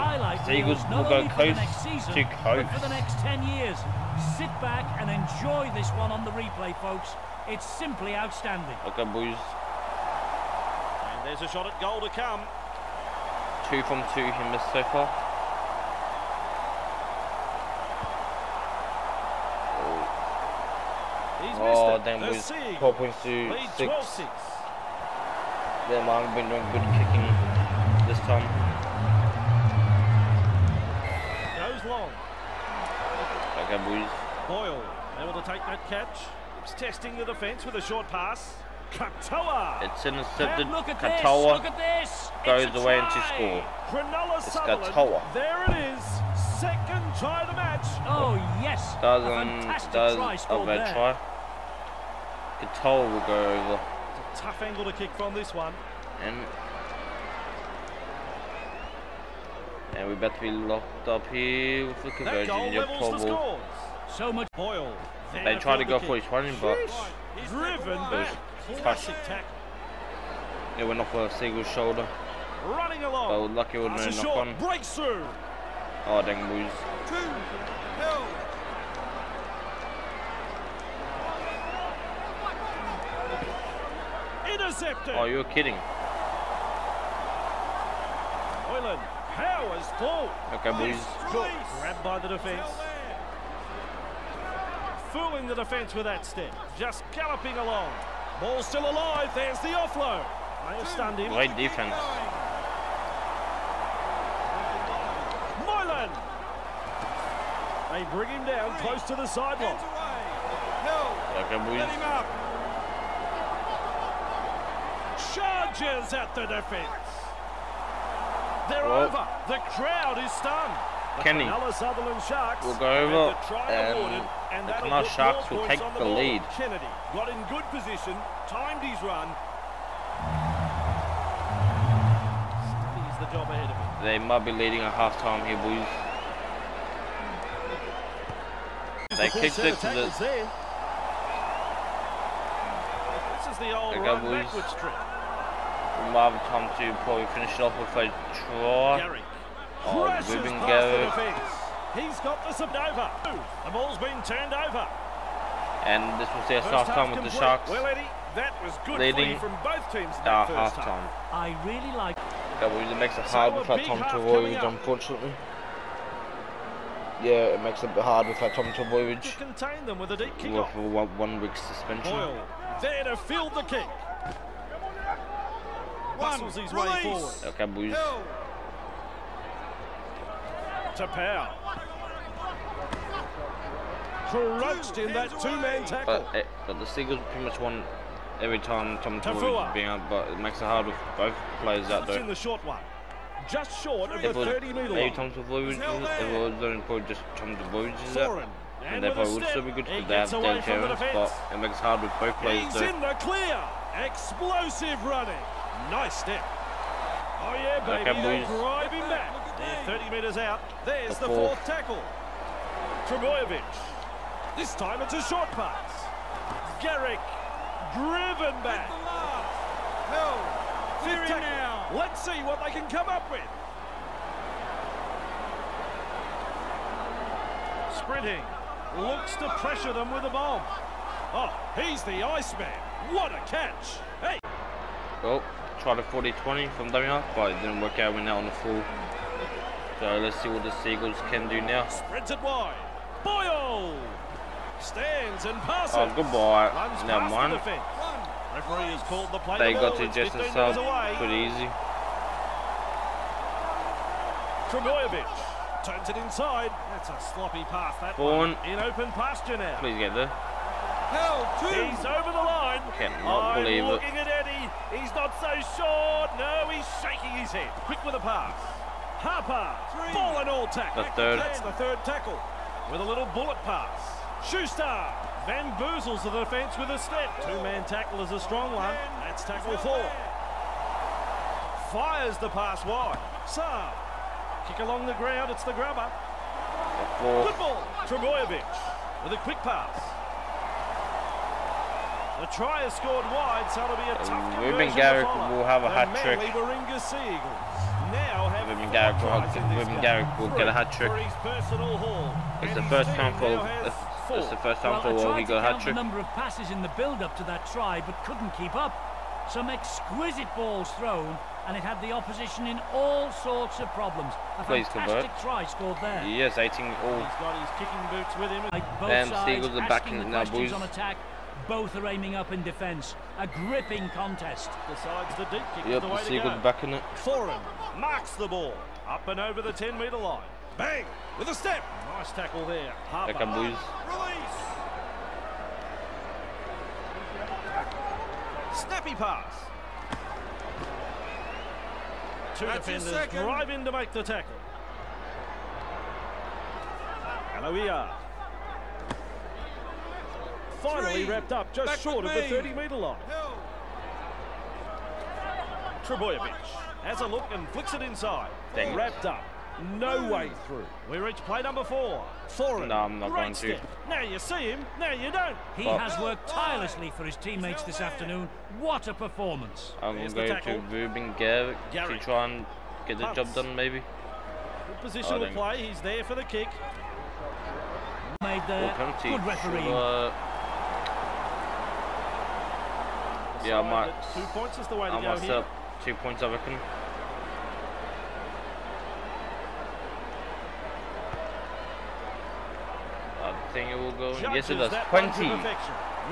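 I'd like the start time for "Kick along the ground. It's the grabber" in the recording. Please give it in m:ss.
4:44.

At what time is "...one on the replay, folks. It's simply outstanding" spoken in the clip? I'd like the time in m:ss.
0:05.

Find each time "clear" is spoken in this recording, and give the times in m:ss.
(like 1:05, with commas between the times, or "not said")
3:23.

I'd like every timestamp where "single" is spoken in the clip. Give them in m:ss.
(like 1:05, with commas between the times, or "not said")
1:11.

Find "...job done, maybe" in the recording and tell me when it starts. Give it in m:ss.
6:13.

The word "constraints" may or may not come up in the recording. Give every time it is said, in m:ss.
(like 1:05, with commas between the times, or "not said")
not said.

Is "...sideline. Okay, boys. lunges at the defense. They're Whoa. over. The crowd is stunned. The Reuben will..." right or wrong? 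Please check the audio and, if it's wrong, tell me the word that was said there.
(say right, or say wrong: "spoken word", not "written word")
wrong: "Kenny", not "Reuben".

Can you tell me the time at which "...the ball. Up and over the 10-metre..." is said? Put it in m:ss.
5:28.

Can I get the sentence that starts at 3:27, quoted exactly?
Oh yeah, baby, they are driving back.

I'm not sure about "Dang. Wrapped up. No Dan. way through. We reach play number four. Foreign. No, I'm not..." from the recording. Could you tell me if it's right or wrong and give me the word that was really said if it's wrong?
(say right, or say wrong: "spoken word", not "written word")
wrong: "Boom", not "Dan".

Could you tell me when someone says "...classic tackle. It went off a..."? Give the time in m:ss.
1:08.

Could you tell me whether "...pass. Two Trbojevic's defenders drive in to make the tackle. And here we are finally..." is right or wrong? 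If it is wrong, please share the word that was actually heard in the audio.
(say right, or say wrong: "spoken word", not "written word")
wrong: "That", not "Trbojevic".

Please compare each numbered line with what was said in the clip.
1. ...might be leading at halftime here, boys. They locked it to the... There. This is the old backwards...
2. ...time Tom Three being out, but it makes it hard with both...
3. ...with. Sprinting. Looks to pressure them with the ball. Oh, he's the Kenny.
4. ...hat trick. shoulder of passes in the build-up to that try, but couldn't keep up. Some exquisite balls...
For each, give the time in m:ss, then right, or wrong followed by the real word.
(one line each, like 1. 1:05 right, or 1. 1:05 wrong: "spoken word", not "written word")
1. 2:14 wrong: "kicked", not "locked"
2. 3:08 wrong: "Tafua", not "Three"
3. 3:43 wrong: "Iceman", not "Kenny"
4. 5:05 wrong: "number", not "shoulder".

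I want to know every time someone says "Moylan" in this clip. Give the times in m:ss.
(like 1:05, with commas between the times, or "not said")
1:45.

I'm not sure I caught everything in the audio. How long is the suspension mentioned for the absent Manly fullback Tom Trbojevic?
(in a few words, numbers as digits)
1 week.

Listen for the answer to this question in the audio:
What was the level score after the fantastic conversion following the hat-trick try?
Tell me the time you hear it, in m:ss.
5:16.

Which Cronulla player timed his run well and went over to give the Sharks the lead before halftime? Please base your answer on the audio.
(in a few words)
Kennedy.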